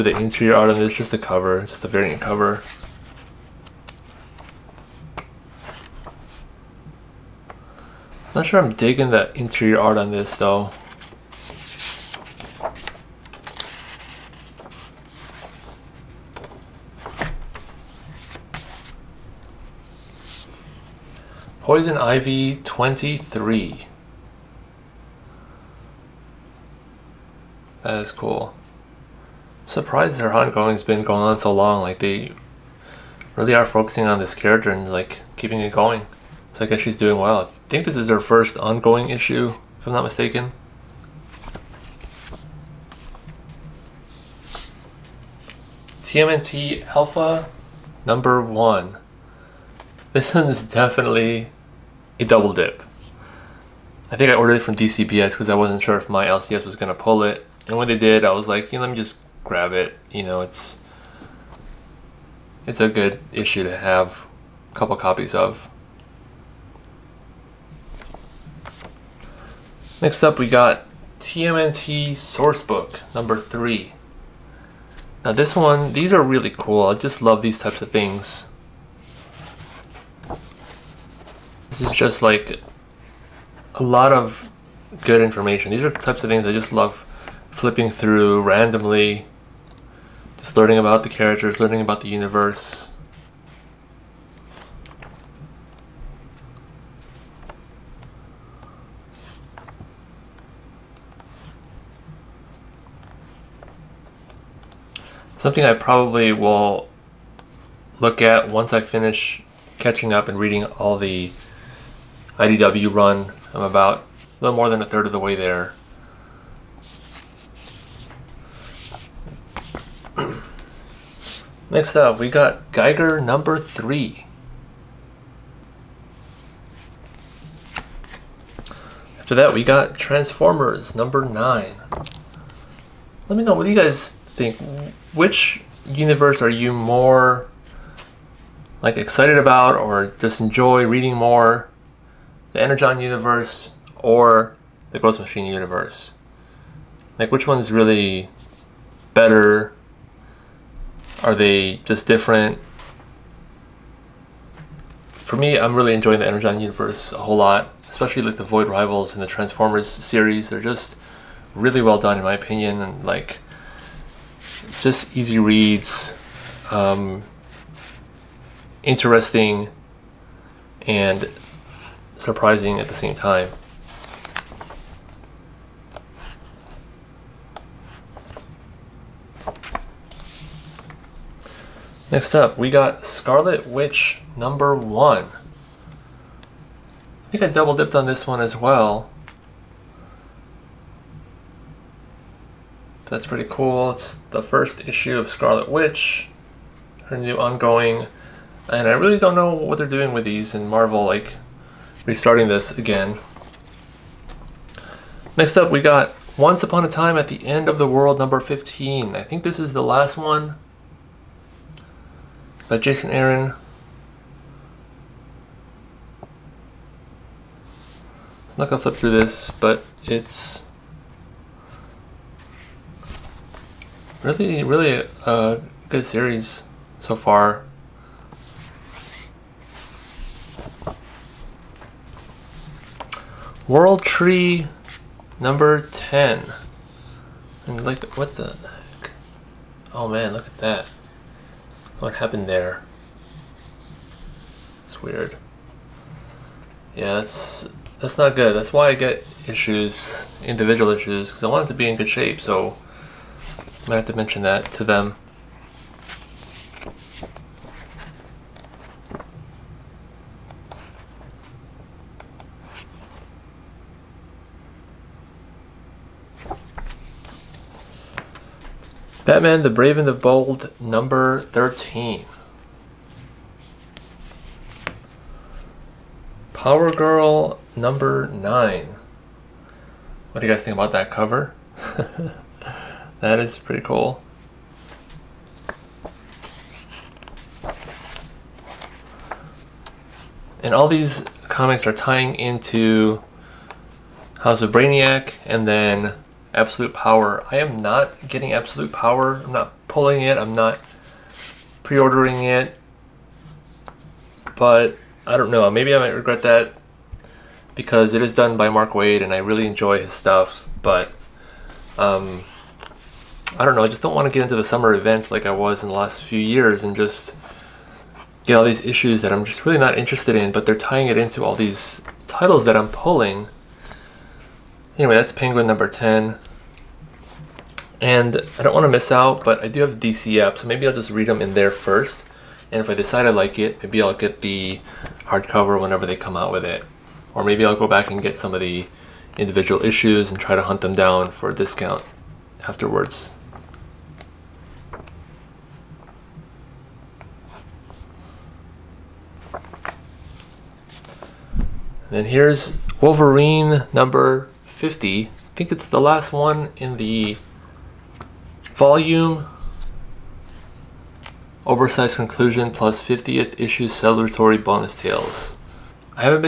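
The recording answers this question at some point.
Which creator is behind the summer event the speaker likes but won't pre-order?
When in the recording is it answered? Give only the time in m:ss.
5:08.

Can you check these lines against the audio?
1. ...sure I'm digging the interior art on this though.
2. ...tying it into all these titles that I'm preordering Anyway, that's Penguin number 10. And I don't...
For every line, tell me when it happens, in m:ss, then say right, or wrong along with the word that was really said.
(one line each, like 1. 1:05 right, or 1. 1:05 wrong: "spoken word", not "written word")
1. 0:08 right
2. 5:20 wrong: "pulling", not "preordering".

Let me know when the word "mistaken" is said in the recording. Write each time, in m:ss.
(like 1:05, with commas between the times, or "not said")
0:40.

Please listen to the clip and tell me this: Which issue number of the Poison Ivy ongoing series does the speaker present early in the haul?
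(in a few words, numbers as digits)
23.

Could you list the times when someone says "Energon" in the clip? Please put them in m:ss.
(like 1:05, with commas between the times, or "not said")
2:22, 2:36.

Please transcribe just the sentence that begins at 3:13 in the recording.
It's the first issue of Scarlet Witch, her new ongoing.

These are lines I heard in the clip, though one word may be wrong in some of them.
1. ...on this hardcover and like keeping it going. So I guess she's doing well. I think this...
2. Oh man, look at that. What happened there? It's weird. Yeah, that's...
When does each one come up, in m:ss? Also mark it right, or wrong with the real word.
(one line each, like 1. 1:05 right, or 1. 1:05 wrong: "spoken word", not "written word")
1. 0:34 wrong: "character", not "hardcover"
2. 3:59 right.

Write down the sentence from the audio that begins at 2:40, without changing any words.
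They're just really well done, in my opinion, and like just easy reads, um, interesting, and surprising at the same time.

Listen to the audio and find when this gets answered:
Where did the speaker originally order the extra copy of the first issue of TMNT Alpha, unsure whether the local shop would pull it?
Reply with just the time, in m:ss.
0:54.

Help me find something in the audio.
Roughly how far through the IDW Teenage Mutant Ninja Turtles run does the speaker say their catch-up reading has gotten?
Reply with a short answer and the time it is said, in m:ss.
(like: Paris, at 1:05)
A little more than a third, at 1:54.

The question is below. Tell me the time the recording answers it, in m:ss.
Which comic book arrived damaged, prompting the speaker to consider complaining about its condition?
3:53.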